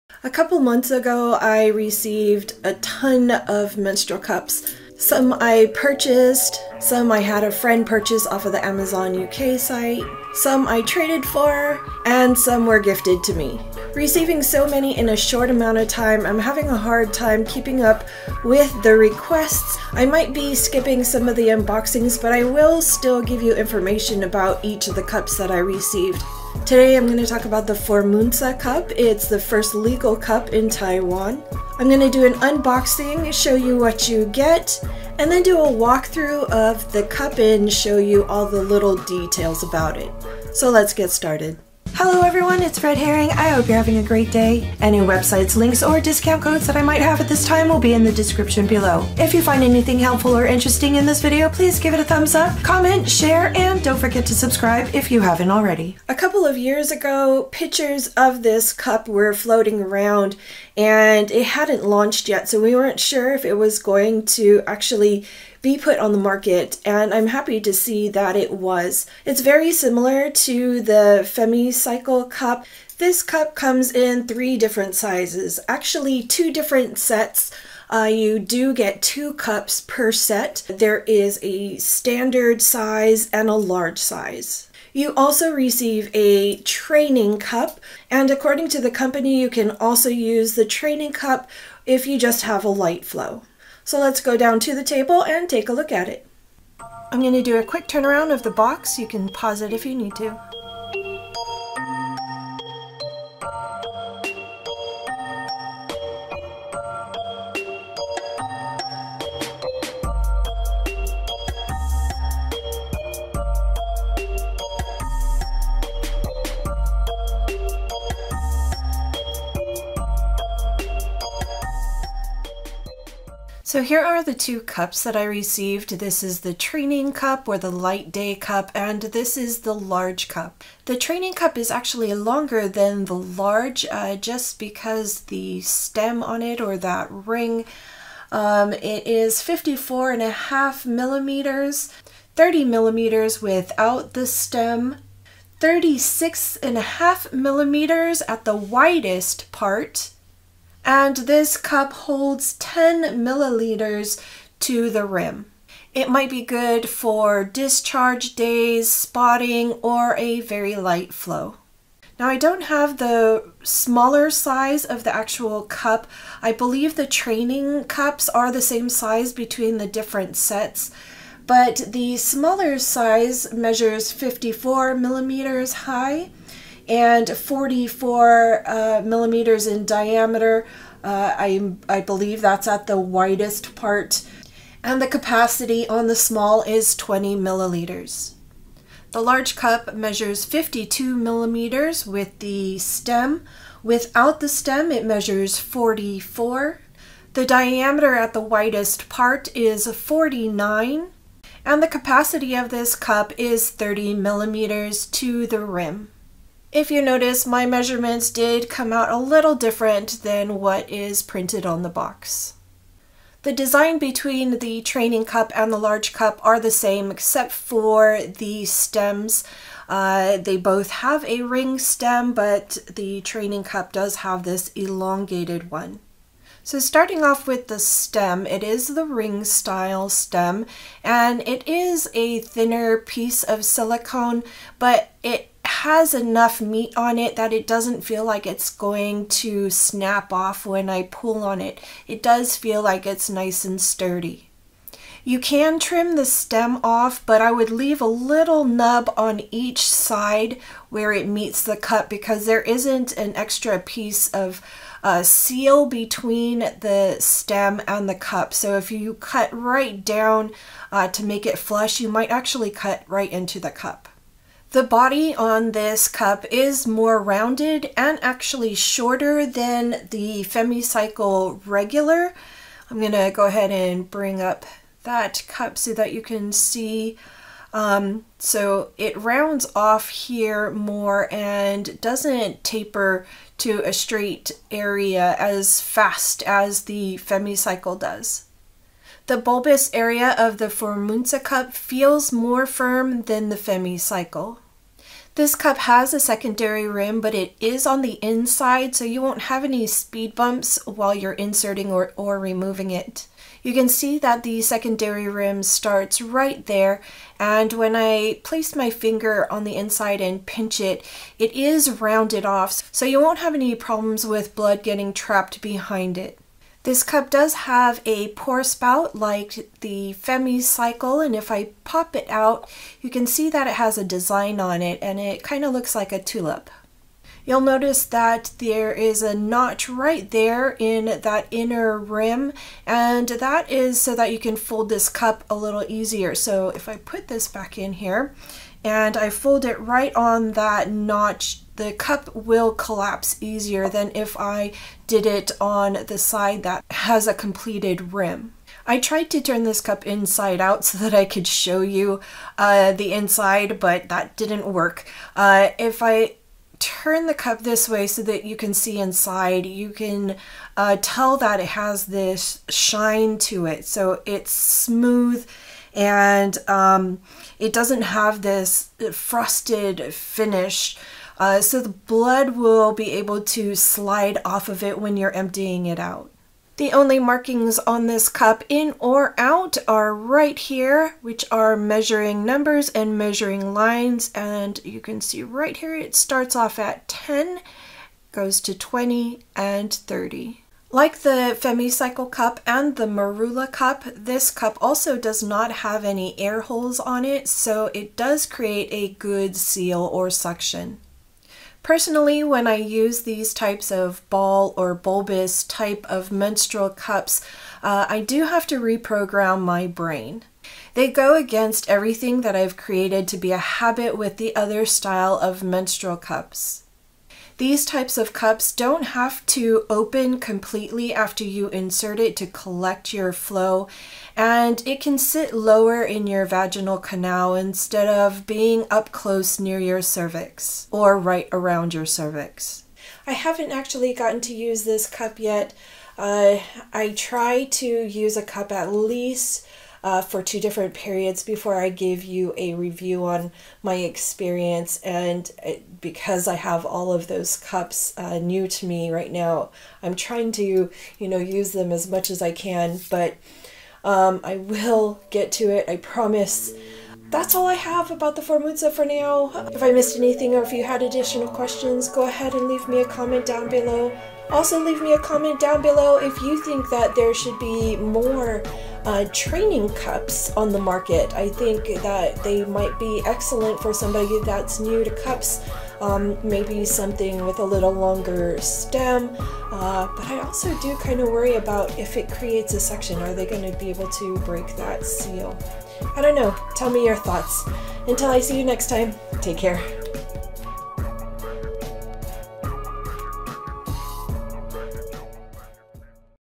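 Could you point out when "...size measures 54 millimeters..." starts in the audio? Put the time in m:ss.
2:52.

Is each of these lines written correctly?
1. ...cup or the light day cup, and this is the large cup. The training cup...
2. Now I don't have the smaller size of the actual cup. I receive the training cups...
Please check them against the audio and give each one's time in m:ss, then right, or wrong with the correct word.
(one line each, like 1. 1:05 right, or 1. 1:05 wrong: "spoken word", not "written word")
1. 2:07 right
2. 2:42 wrong: "believe", not "receive".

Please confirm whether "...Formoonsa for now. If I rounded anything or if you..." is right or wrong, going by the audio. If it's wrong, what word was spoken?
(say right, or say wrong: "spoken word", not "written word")
wrong: "missed", not "rounded".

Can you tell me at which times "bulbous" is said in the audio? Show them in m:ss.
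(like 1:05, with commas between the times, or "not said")
4:49, 6:44.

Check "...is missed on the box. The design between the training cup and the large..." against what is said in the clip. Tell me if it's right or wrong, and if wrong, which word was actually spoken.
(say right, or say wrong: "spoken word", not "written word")
wrong: "printed", not "missed".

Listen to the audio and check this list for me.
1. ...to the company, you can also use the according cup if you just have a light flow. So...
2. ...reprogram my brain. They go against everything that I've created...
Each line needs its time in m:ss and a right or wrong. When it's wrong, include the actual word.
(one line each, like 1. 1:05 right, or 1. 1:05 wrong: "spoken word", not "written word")
1. 1:28 wrong: "training", not "according"
2. 6:48 right.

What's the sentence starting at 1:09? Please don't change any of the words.
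It's very similar to the FemmyCycle Cup.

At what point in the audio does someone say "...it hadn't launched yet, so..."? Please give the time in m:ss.
1:01.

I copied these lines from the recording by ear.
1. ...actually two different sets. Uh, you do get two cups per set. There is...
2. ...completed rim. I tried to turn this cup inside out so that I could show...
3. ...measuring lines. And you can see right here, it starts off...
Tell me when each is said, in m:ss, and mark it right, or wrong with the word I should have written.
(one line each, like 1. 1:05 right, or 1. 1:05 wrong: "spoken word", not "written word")
1. 1:15 right
2. 5:47 right
3. 6:23 right.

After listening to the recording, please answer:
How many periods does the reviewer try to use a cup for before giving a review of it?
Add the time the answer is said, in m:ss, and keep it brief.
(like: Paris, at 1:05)
2, at 7:20.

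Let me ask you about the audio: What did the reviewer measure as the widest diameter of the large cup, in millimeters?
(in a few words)
49.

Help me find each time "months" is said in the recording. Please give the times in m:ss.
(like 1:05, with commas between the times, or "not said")
0:00.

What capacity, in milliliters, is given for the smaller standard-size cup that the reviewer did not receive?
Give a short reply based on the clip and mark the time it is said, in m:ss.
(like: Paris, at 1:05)
20, at 3:06.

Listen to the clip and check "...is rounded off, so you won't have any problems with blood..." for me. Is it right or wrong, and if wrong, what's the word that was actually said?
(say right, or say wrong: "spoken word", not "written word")
right.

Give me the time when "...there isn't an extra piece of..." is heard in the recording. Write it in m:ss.
4:12.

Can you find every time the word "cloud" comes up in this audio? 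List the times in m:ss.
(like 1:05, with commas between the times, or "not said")
not said.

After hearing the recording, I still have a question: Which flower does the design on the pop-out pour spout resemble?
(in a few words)
tulip.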